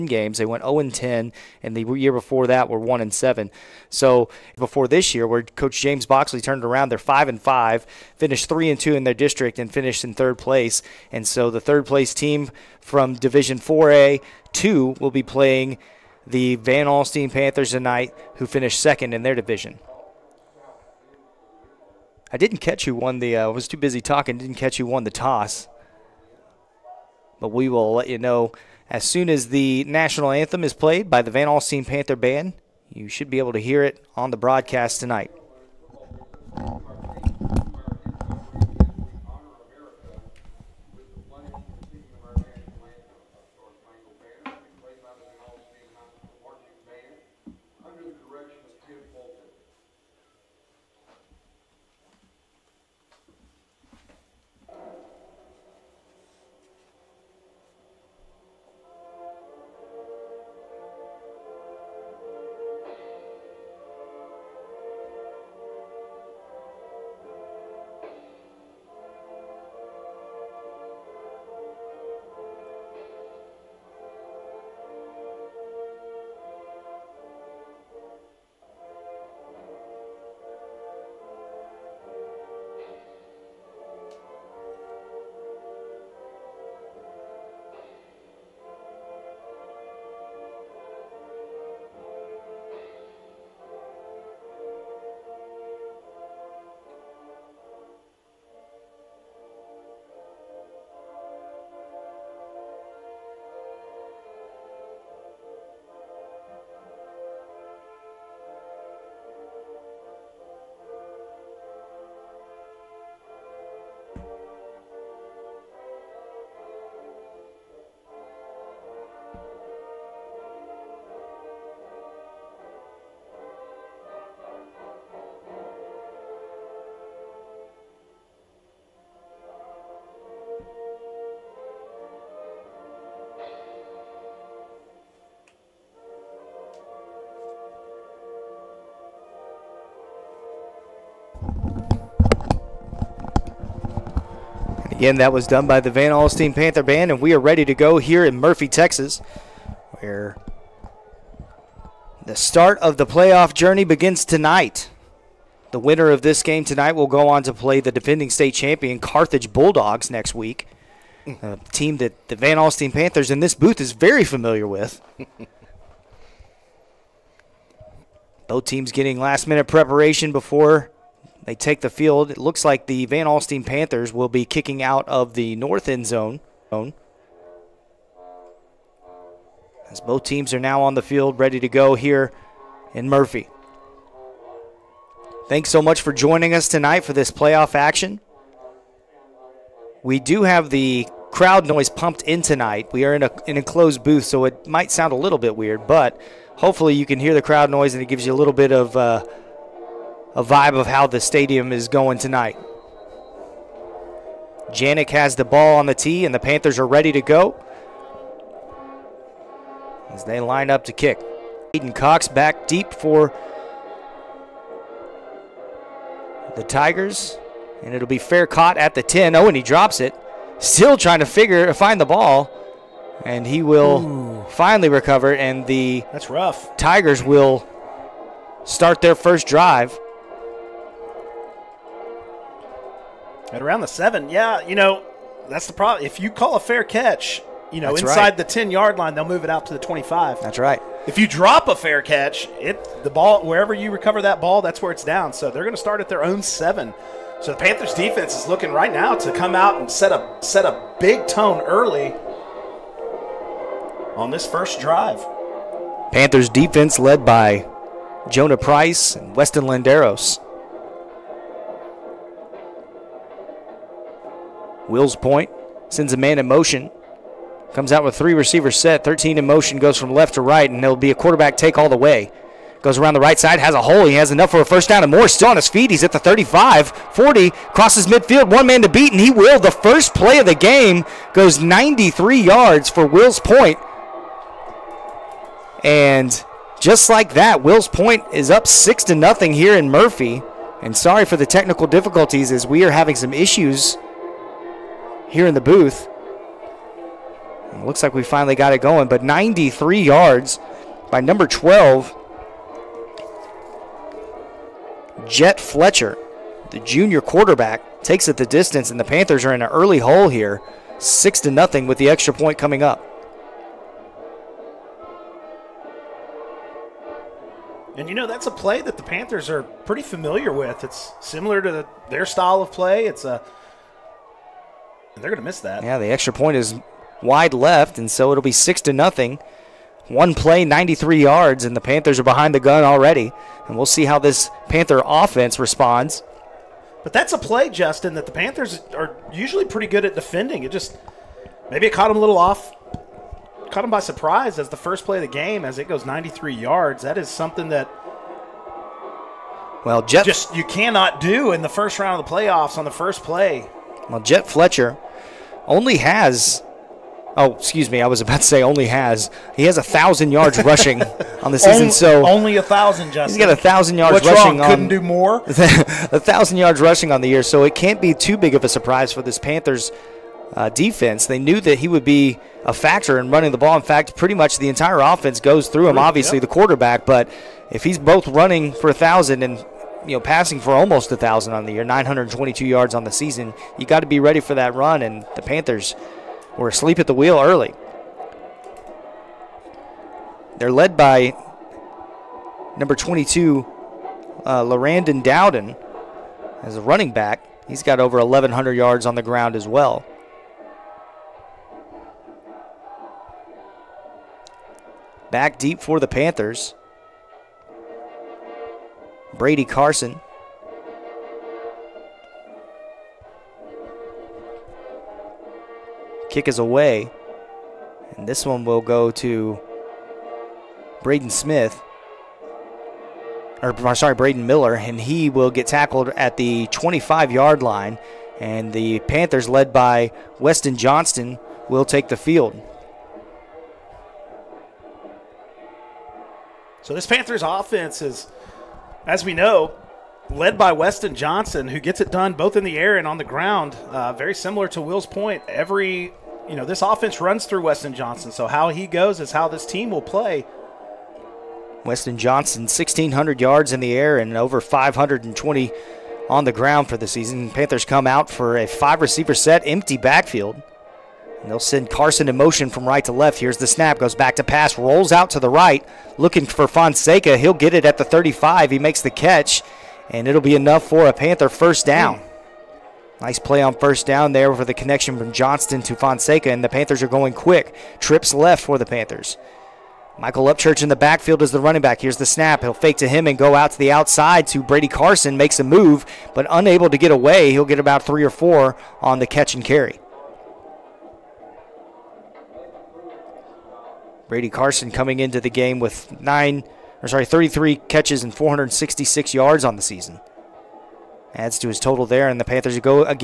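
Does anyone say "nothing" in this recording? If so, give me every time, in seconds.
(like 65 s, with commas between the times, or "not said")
289 s, 311 s, 328 s.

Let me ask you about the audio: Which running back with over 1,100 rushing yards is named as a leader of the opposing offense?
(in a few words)
Larandon Dowden.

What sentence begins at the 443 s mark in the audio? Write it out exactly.
Uh, very similar to Will's point.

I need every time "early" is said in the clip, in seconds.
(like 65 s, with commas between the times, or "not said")
251 s, 309 s, 387 s.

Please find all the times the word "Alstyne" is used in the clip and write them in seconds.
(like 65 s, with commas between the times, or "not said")
16 s, 31 s, 146 s, 162 s, 173 s.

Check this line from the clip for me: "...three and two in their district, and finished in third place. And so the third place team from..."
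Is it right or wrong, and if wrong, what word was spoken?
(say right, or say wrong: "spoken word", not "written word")
right.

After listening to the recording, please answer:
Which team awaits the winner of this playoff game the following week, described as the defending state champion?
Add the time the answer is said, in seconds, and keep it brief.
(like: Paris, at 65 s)
Carthage Bulldogs, at 158 s.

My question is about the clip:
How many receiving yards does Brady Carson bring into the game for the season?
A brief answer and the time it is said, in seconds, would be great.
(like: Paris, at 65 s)
466, at 498 s.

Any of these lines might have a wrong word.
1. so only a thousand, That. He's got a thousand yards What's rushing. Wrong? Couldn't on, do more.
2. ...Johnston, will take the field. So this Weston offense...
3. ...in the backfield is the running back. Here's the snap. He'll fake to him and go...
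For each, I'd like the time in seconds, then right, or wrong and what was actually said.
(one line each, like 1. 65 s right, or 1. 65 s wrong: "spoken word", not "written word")
1. 361 s wrong: "Justin", not "That"
2. 430 s wrong: "Panthers", not "Weston"
3. 480 s right.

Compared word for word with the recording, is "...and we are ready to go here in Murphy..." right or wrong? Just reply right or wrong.
right.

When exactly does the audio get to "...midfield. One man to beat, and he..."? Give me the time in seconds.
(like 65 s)
278 s.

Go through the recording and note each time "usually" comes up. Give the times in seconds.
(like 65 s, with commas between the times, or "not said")
339 s.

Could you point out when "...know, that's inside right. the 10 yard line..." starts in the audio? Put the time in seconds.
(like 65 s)
237 s.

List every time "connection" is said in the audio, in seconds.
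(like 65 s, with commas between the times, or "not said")
474 s.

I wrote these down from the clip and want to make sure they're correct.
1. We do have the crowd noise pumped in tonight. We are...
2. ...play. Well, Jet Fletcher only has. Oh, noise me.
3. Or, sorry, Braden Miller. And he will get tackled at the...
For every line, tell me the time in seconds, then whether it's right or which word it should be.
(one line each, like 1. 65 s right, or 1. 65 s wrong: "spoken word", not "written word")
1. 190 s right
2. 353 s wrong: "excuse", not "noise"
3. 423 s right.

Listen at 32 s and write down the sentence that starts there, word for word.
You should be able to hear it on the broadcast tonight.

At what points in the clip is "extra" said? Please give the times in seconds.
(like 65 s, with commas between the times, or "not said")
312 s, 326 s.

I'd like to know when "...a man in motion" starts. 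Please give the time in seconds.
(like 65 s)
266 s.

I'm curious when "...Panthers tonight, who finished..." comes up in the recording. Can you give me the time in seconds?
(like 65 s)
17 s.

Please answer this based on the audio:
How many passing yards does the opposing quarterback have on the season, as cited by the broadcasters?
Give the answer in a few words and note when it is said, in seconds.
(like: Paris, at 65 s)
922, at 381 s.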